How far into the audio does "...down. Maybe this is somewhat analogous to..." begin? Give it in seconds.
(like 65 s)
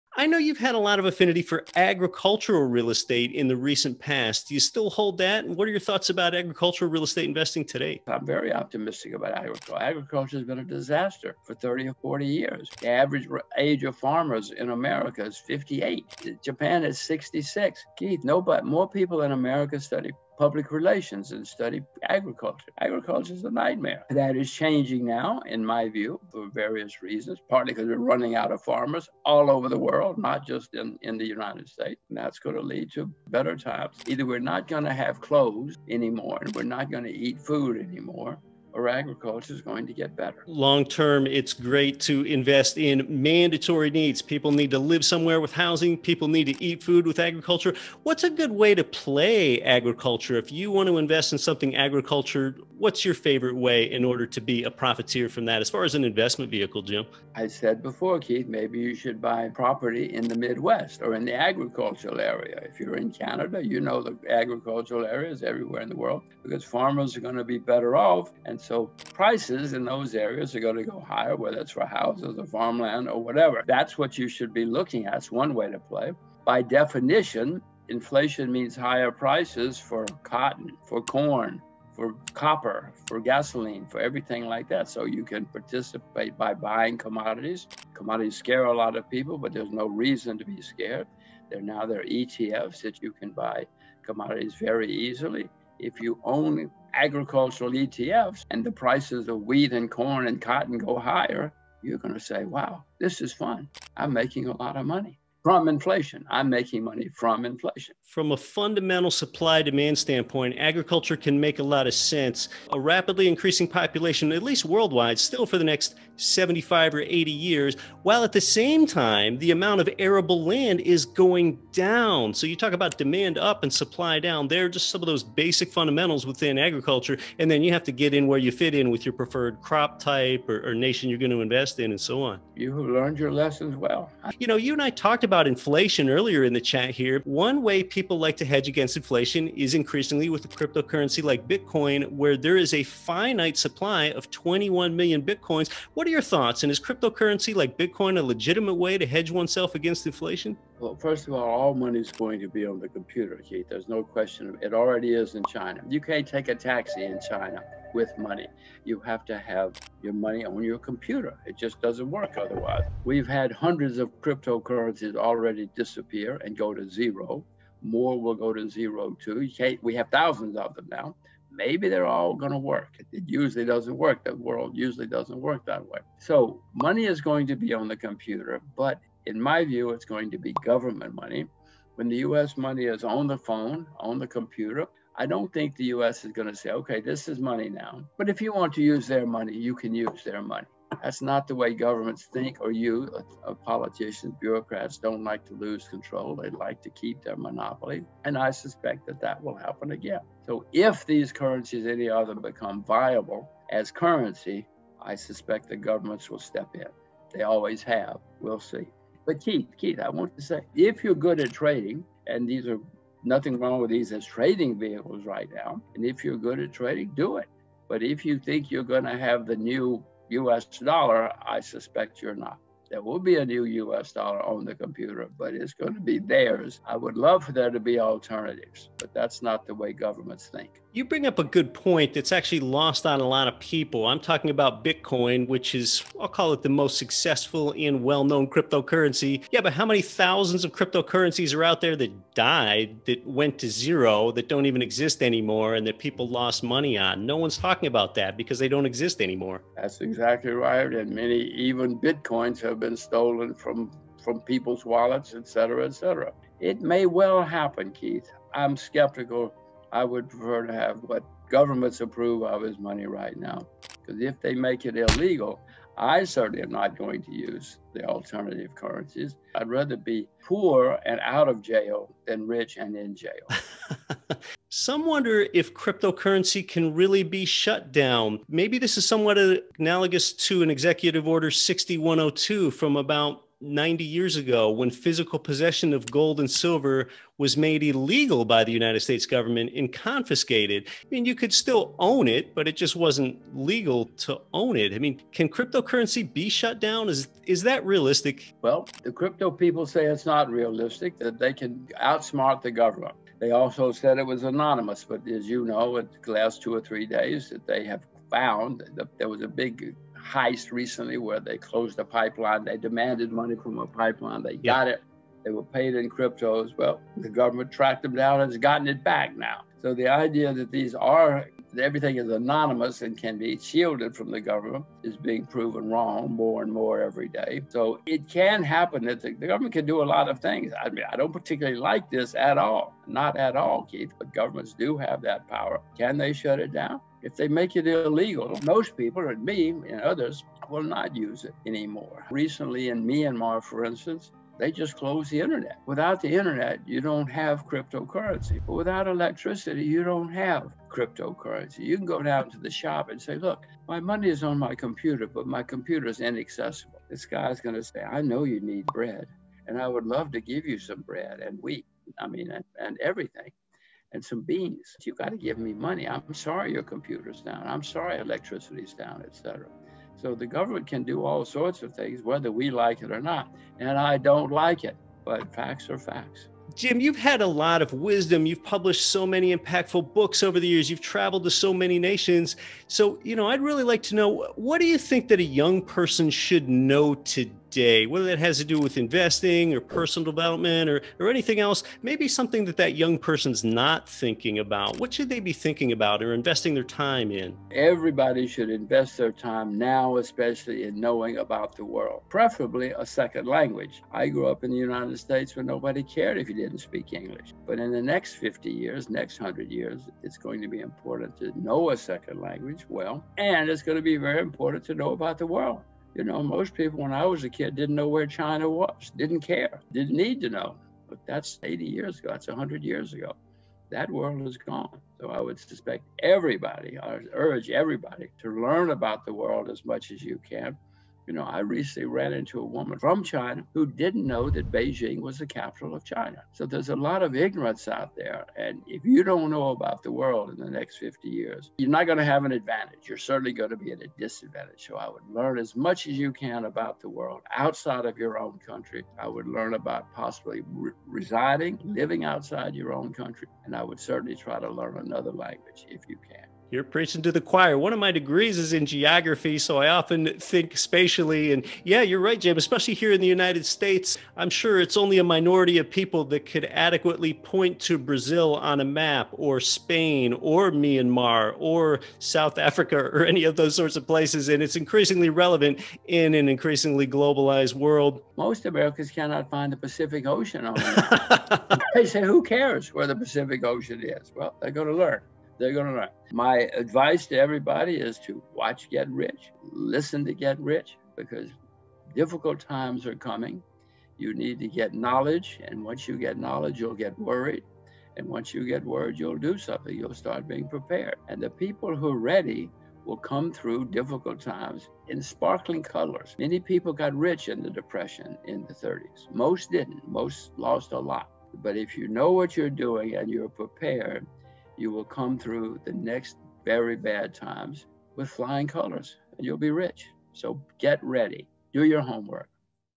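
277 s.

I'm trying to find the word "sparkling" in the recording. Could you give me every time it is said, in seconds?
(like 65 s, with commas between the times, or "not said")
505 s.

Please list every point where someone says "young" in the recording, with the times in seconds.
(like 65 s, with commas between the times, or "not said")
385 s, 392 s.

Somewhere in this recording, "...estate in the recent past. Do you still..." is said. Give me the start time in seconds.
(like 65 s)
2 s.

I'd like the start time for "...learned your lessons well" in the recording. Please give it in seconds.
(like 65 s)
132 s.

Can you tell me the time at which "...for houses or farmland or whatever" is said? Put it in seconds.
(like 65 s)
71 s.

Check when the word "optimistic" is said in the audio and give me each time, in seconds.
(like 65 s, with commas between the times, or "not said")
8 s.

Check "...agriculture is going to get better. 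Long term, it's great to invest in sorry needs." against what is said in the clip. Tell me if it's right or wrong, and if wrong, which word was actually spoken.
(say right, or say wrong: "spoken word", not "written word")
wrong: "mandatory", not "sorry".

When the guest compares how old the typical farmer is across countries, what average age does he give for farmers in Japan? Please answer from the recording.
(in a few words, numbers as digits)
66.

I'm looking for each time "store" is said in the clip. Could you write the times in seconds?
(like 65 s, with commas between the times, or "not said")
not said.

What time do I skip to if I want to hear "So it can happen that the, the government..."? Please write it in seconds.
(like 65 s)
327 s.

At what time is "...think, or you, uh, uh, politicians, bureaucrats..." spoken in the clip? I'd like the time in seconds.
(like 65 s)
192 s.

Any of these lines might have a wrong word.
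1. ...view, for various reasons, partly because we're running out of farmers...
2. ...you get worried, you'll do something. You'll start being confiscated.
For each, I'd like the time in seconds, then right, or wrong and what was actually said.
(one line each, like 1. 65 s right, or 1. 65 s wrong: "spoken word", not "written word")
1. 25 s right
2. 498 s wrong: "prepared", not "confiscated".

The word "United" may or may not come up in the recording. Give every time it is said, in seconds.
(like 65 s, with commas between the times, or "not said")
31 s, 288 s, 404 s, 463 s.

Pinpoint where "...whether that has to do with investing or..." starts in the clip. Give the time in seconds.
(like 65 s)
388 s.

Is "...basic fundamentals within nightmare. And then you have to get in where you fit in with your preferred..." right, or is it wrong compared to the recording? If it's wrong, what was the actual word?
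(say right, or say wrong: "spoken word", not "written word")
wrong: "agriculture", not "nightmare".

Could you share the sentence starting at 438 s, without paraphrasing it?
And if you don't know about the world in the next 50 years, you're not going to have an advantage.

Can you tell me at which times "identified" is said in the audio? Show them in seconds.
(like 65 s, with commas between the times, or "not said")
not said.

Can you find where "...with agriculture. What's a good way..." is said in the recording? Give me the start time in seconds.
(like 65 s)
47 s.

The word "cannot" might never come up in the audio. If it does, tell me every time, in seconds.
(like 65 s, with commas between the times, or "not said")
479 s.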